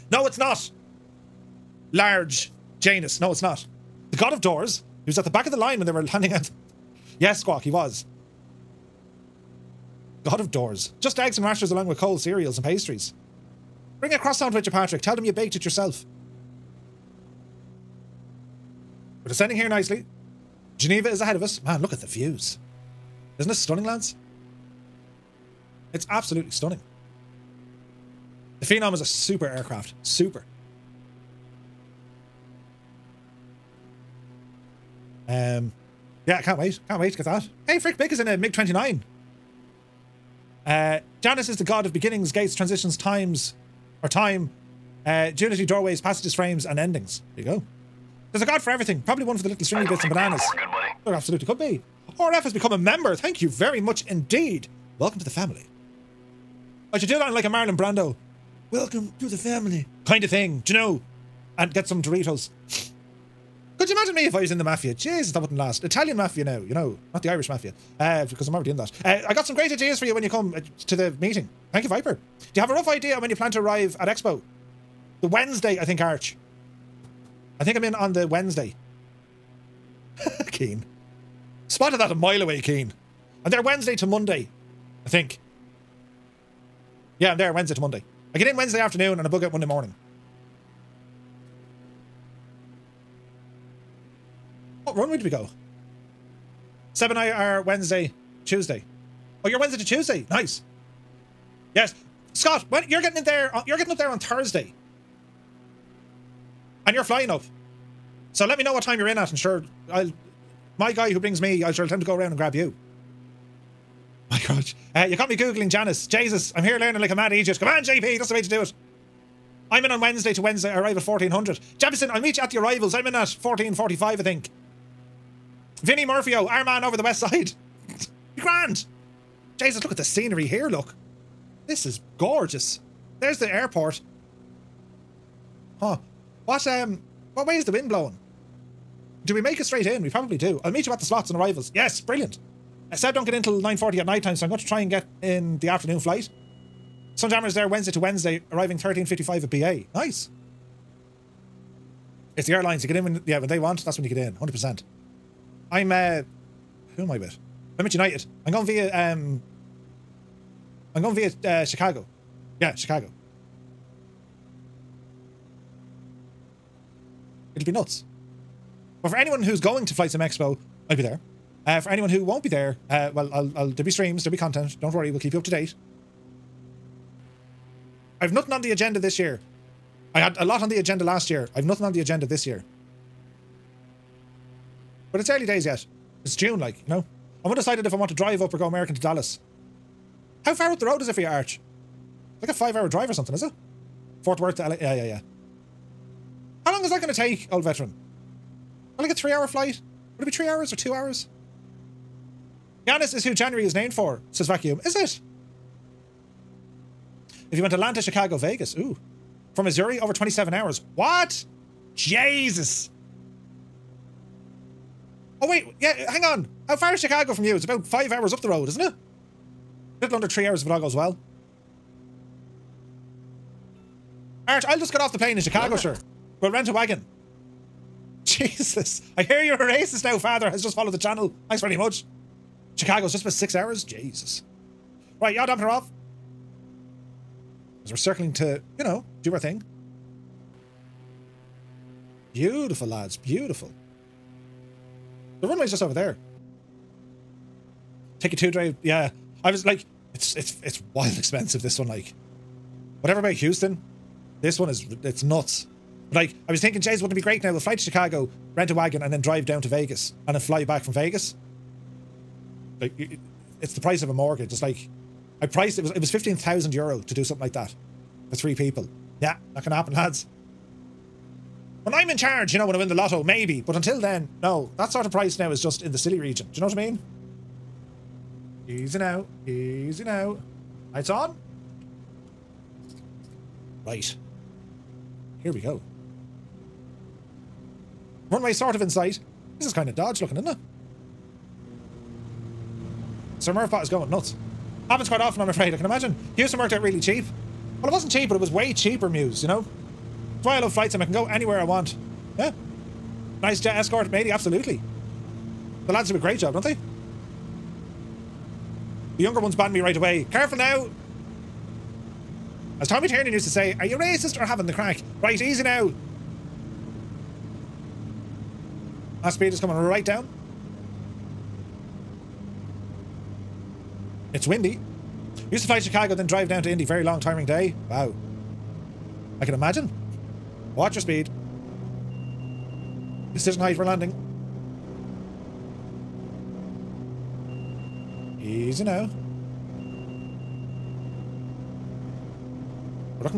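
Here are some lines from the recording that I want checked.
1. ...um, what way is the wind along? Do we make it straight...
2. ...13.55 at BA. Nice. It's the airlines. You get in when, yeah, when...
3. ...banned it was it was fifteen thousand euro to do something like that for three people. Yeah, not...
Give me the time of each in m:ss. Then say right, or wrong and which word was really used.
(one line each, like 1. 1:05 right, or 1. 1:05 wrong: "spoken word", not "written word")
1. 2:16 wrong: "blowing", not "along"
2. 2:28 right
3. 4:25 wrong: "priced", not "banned".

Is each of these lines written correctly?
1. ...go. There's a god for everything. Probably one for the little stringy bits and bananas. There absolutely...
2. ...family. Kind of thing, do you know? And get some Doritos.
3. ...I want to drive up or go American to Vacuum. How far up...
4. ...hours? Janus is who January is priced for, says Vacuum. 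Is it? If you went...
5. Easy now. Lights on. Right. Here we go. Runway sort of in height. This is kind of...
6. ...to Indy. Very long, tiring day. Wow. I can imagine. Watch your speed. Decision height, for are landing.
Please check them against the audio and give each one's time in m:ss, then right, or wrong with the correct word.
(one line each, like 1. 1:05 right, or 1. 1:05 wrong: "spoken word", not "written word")
1. 0:47 right
2. 0:59 right
3. 3:07 wrong: "Dallas", not "Vacuum"
4. 3:20 wrong: "named", not "priced"
5. 4:39 wrong: "sight", not "height"
6. 5:26 right.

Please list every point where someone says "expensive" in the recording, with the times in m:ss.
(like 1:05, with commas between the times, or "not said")
4:11.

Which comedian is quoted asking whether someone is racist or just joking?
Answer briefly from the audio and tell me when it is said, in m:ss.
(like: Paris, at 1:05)
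Tommy Tiernan, at 5:12.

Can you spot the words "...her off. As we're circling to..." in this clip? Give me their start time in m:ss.
3:55.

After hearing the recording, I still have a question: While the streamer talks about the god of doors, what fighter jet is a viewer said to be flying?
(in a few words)
MiG-29.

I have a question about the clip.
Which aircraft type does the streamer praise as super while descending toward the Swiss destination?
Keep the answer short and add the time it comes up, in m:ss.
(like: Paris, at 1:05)
Phenom, at 0:28.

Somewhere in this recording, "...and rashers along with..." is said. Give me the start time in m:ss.
0:11.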